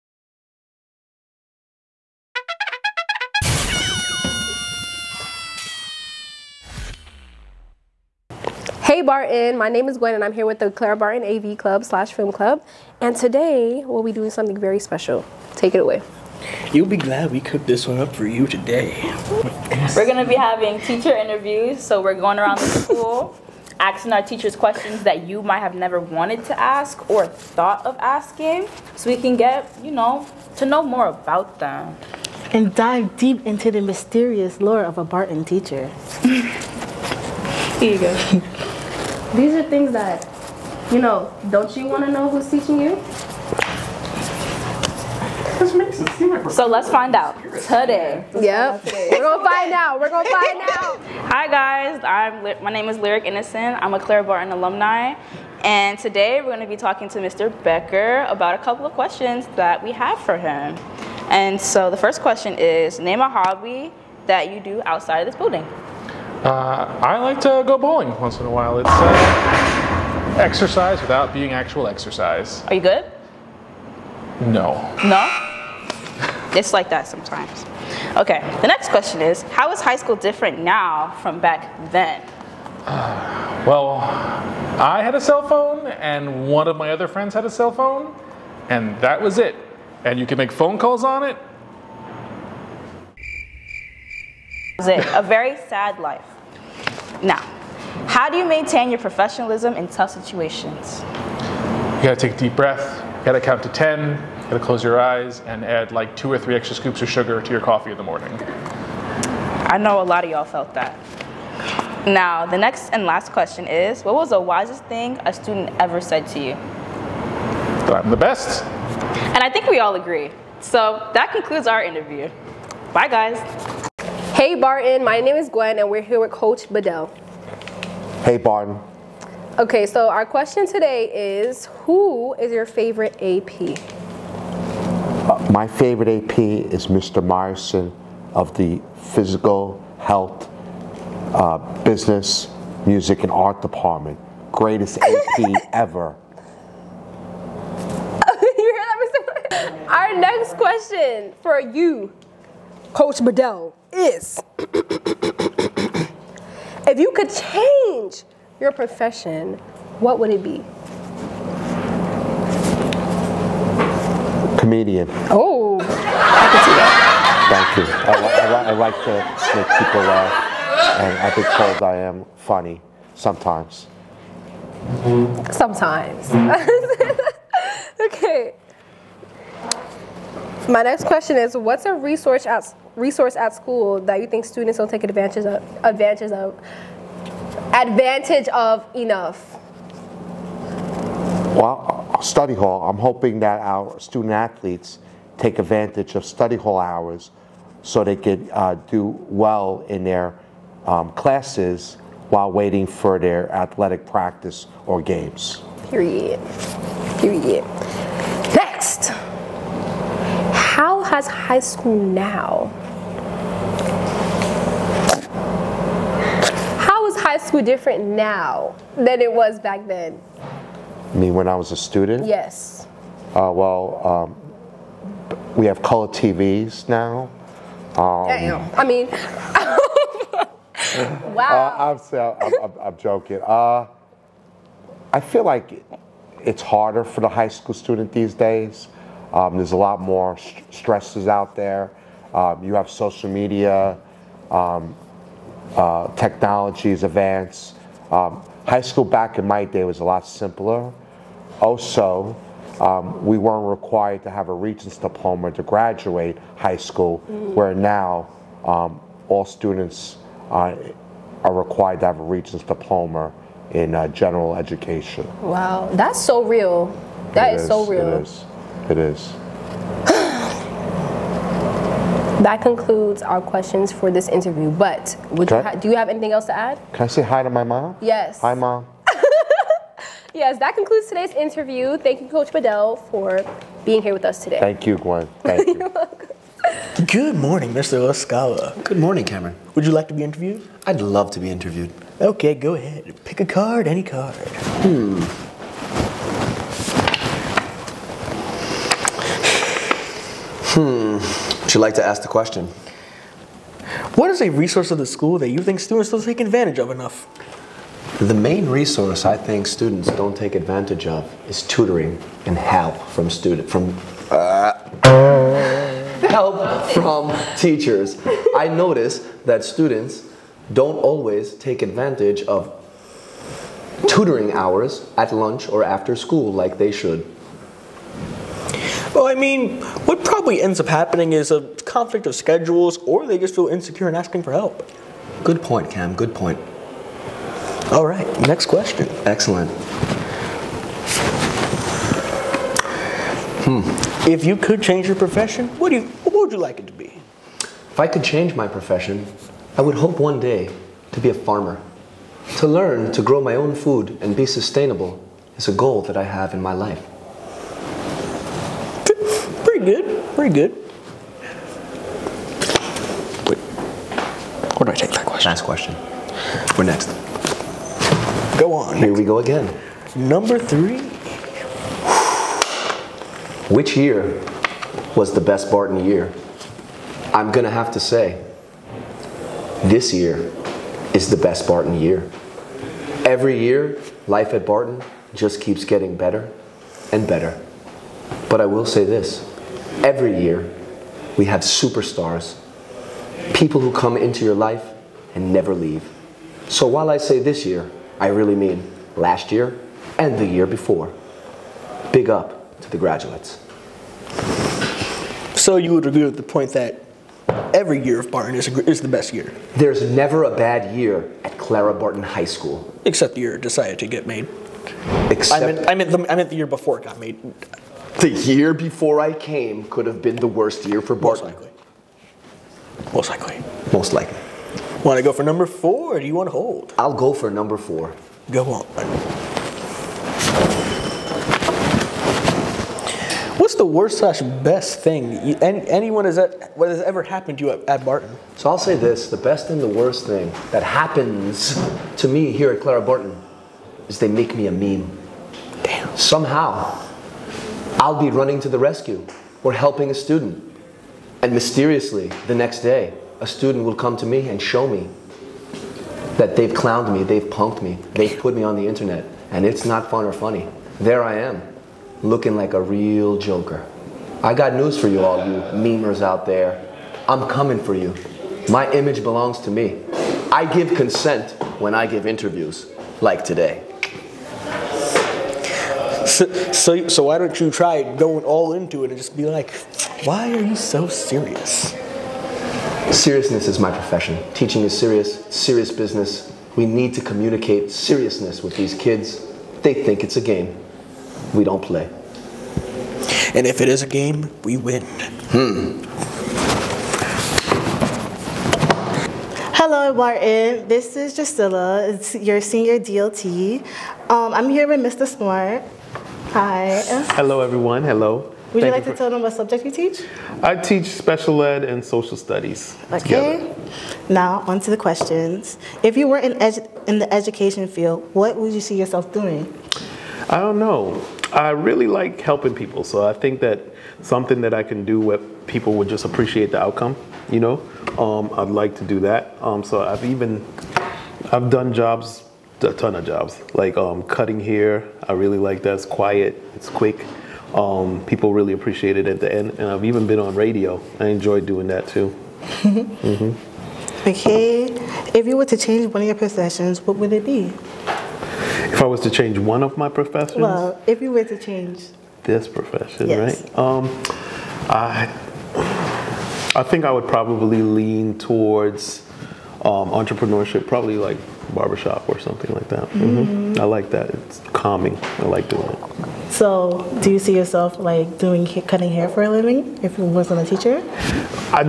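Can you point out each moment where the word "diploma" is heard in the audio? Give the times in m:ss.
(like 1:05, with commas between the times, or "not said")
4:14, 4:22.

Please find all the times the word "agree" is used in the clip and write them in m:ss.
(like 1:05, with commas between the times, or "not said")
1:59, 6:46.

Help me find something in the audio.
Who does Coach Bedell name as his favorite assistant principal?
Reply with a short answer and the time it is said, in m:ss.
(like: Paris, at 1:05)
Mr. Morrison, at 2:16.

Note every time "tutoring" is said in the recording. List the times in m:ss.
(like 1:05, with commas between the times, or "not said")
5:11, 5:24.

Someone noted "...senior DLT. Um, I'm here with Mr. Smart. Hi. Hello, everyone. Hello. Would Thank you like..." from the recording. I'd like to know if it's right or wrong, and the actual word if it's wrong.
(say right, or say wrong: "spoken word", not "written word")
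right.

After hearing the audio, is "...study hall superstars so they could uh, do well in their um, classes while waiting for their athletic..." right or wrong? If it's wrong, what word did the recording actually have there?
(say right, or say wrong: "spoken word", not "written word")
wrong: "hours", not "superstars".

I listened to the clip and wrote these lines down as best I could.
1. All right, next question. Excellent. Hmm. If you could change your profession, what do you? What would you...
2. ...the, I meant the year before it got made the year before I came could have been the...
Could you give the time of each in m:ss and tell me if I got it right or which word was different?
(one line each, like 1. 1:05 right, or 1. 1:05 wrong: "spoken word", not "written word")
1. 5:37 right
2. 6:56 right.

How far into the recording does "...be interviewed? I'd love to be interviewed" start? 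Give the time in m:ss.
4:50.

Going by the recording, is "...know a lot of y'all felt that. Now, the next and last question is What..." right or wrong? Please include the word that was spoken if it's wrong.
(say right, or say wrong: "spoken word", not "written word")
right.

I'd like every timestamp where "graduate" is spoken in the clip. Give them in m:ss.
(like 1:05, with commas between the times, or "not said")
4:15, 6:42.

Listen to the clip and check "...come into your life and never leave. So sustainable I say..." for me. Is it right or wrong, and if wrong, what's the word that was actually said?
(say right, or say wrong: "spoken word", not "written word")
wrong: "while", not "sustainable".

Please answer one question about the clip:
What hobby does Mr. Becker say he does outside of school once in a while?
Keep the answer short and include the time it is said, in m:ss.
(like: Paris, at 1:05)
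Bowling, at 1:07.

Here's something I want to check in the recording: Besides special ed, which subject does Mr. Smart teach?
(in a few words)
Social studies.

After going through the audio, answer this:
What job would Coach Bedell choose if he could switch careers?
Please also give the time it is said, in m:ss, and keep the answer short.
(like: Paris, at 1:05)
Comedian, at 2:44.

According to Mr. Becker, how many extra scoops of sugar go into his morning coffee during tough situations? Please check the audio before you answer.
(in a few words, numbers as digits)
2 or 3.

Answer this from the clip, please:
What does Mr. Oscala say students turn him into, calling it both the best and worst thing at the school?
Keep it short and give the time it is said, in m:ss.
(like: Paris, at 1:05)
A meme, at 7:24.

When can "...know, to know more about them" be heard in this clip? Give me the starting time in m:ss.
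0:29.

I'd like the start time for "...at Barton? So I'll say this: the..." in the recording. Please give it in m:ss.
7:17.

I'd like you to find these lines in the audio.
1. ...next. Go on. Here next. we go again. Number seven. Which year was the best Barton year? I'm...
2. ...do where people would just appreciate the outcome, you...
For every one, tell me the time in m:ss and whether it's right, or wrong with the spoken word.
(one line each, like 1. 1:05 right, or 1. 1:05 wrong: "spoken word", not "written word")
1. 6:06 wrong: "three", not "seven"
2. 8:45 right.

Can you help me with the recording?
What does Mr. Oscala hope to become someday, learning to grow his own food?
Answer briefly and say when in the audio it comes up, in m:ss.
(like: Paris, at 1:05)
Farmer, at 5:51.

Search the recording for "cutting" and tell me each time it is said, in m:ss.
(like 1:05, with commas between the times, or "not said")
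8:54, 9:28.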